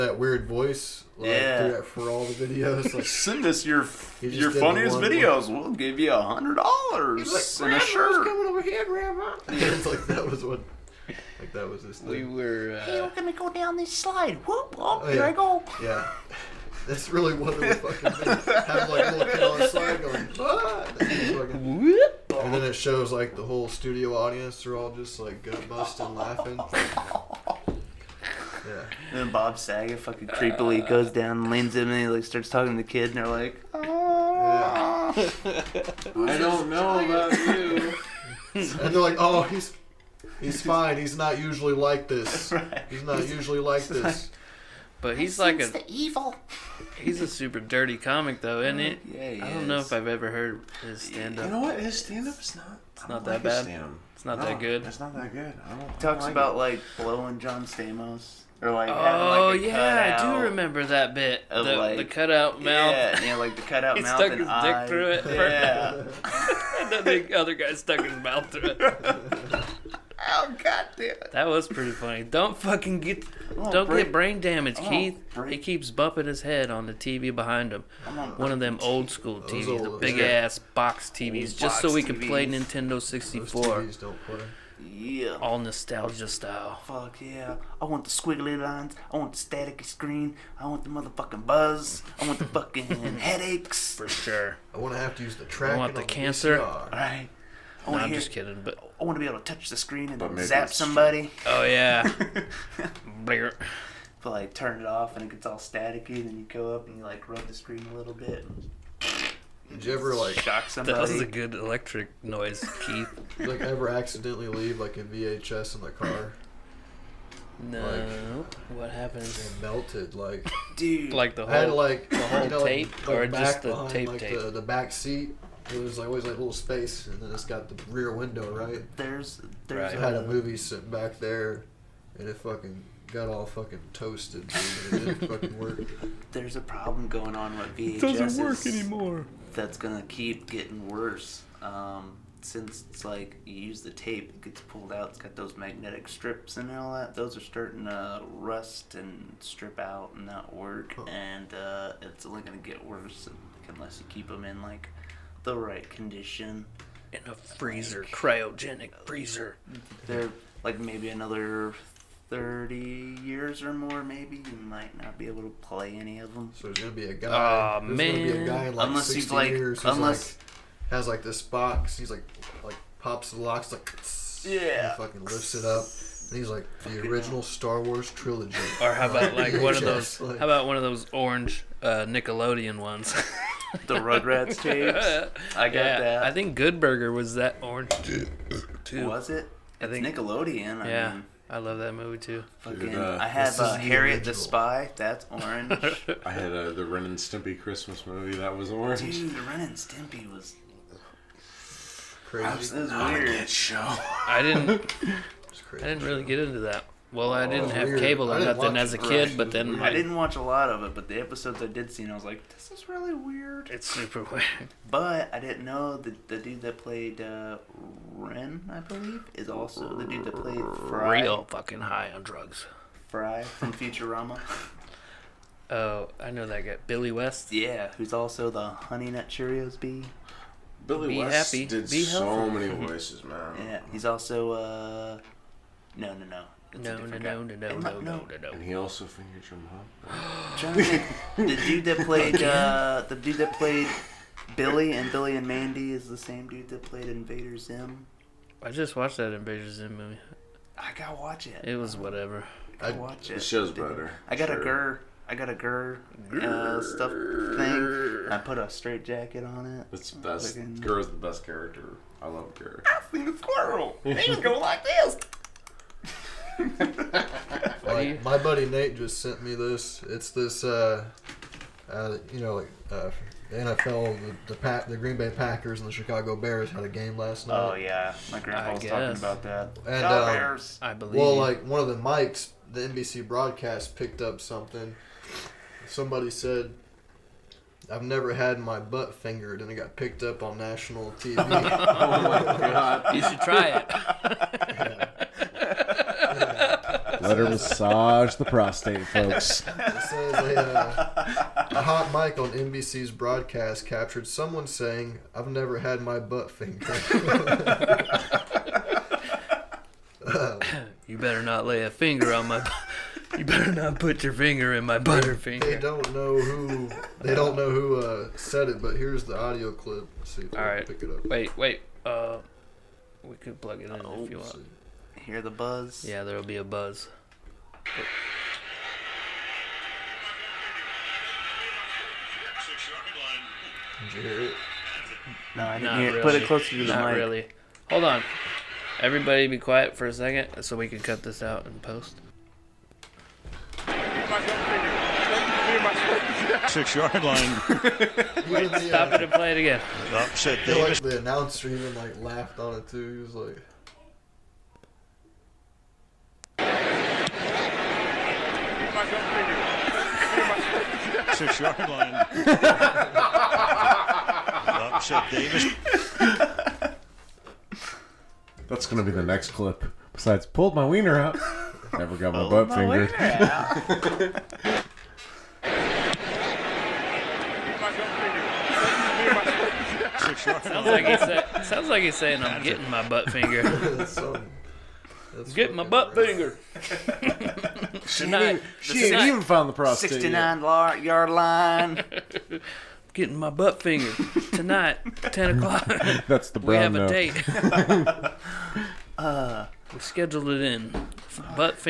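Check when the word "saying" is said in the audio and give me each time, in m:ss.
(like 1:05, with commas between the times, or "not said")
5:04, 6:22.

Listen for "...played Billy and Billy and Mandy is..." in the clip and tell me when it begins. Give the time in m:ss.
4:03.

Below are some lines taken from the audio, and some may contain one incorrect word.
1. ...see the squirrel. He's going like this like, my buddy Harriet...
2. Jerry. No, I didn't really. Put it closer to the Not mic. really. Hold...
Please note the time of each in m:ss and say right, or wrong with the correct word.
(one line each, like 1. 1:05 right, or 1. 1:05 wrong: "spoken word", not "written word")
1. 4:23 wrong: "Nate", not "Harriet"
2. 5:34 right.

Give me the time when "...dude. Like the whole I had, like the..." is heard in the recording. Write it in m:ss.
2:00.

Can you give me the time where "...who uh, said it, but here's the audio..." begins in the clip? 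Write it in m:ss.
5:17.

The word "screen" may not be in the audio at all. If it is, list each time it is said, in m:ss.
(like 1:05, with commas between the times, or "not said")
1:29, 1:39, 1:47.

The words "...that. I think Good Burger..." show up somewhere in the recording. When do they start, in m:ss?
3:05.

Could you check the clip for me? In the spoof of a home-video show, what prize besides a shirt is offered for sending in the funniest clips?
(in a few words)
$100.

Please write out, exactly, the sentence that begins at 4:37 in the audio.
Oh yeah, my grandpa I was guess.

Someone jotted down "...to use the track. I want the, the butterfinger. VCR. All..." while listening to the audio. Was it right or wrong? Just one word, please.
wrong.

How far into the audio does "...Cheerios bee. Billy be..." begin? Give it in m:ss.
3:49.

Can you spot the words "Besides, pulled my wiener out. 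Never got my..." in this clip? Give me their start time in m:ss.
6:10.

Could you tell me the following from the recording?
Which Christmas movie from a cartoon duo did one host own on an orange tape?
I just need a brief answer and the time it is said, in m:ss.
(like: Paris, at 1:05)
Ren and Stimpy Christmas, at 3:16.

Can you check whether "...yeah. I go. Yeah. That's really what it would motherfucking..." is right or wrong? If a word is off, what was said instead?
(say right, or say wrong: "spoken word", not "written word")
wrong: "fucking", not "motherfucking".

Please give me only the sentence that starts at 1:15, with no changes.
He keeps bumping his head on the TV behind him.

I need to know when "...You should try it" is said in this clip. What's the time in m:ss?
4:53.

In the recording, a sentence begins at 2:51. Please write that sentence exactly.
He's like, like pops the locks, like, yeah.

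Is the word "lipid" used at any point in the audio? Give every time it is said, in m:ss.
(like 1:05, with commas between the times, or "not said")
not said.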